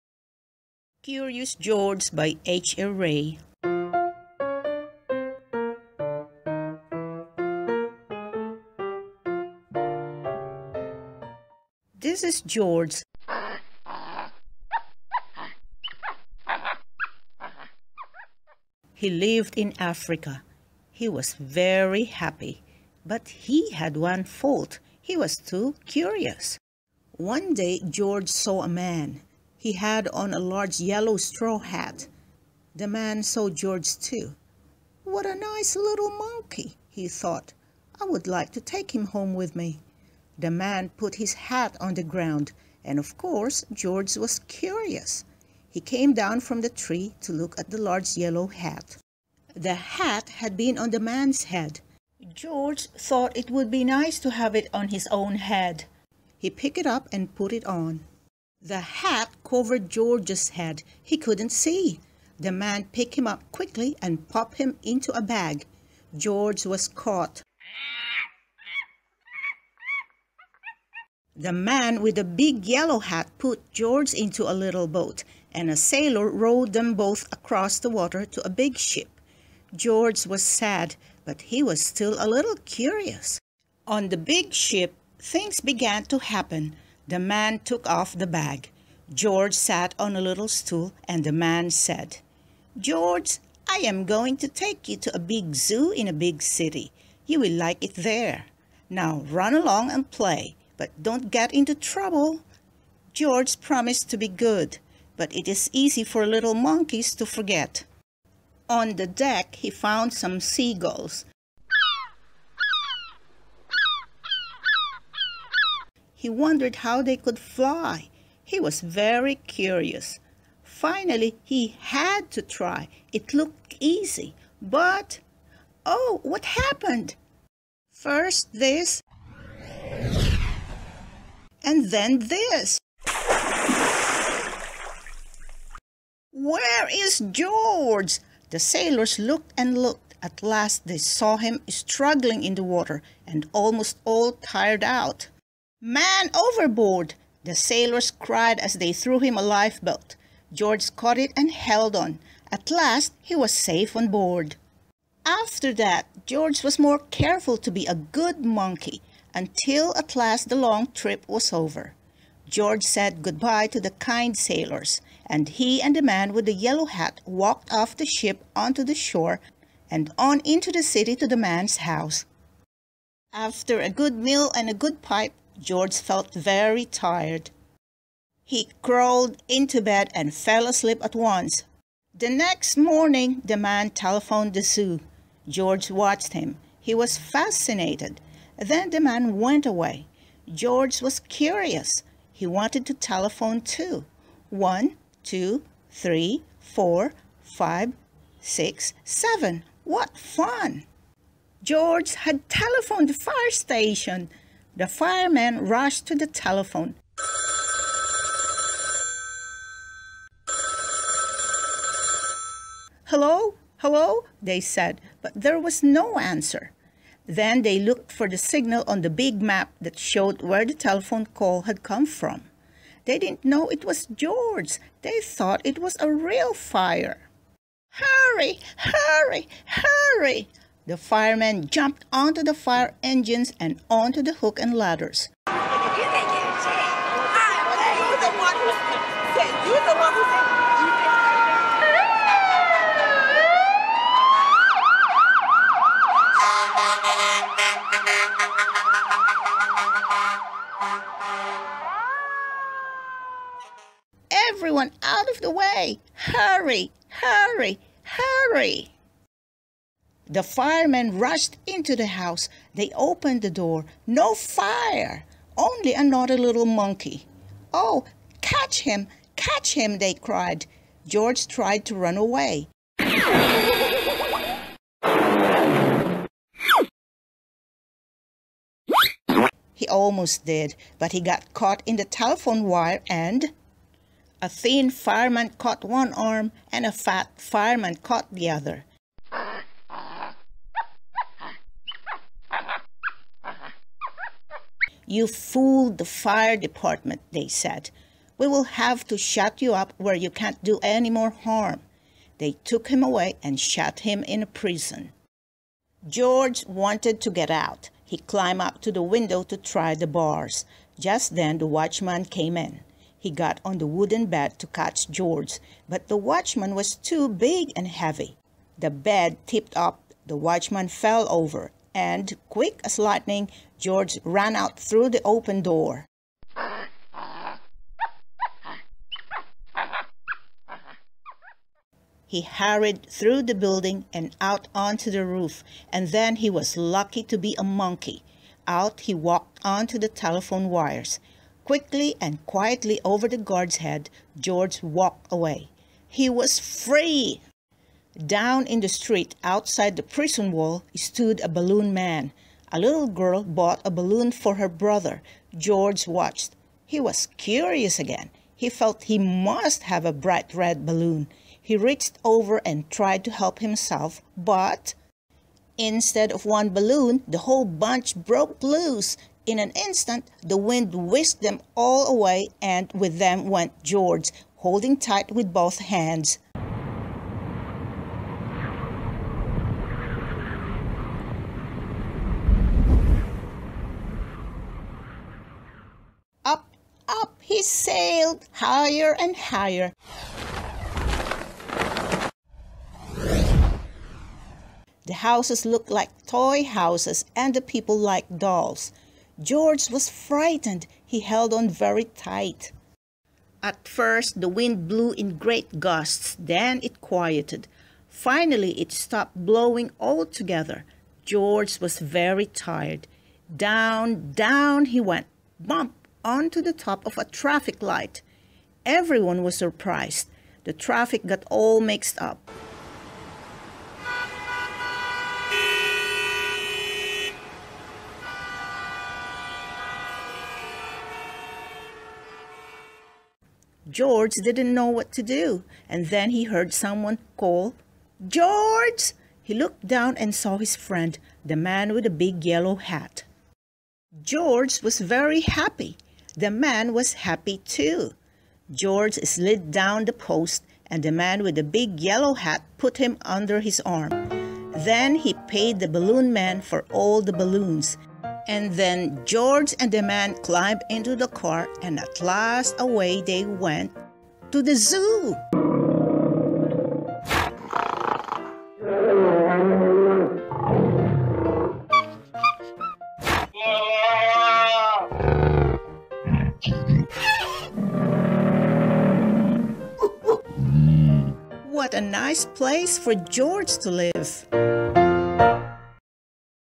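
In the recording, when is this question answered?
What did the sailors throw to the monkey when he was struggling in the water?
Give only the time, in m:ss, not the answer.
2:29.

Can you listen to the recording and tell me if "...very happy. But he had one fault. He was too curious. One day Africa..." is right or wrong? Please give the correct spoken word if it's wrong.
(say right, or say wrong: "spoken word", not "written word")
wrong: "George", not "Africa".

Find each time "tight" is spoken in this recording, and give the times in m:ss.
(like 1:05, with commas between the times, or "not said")
6:14, 6:42.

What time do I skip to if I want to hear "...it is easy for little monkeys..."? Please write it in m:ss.
1:45.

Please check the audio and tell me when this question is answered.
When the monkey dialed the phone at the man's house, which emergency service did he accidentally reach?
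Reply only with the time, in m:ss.
3:23.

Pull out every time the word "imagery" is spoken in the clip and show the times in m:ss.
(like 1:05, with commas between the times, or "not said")
not said.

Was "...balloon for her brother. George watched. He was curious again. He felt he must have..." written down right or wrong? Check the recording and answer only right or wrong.
right.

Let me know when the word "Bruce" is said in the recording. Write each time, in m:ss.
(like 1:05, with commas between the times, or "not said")
not said.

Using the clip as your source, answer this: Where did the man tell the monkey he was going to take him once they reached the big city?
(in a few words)
A big zoo.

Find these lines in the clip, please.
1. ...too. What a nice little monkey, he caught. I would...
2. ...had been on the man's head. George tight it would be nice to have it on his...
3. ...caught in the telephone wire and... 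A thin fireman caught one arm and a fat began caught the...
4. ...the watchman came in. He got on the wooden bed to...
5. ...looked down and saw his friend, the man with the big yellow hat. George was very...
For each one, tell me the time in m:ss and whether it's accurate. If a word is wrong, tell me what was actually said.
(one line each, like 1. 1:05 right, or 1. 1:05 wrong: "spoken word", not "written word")
1. 0:33 wrong: "thought", not "caught"
2. 0:50 wrong: "thought", not "tight"
3. 4:41 wrong: "fireman", not "began"
4. 5:11 right
5. 7:19 right.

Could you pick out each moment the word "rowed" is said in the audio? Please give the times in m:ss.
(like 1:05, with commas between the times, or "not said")
1:16.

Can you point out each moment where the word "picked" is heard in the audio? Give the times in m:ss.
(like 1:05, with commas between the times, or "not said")
0:56, 1:02.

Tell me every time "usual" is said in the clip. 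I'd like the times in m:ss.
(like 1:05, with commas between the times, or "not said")
not said.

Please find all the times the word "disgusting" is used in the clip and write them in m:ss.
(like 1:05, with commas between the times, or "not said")
not said.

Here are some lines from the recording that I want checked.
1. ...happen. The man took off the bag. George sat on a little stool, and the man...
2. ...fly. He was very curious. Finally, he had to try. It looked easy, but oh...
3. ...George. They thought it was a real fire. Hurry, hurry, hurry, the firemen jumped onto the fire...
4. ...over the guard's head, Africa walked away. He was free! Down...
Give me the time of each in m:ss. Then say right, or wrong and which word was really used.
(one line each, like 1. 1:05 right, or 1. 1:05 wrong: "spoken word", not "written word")
1. 1:26 right
2. 1:57 right
3. 3:44 right
4. 5:43 wrong: "George", not "Africa".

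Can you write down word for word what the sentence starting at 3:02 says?
The next morning, the man telephoned the zoo.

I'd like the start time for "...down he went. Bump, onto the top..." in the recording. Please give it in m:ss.
6:54.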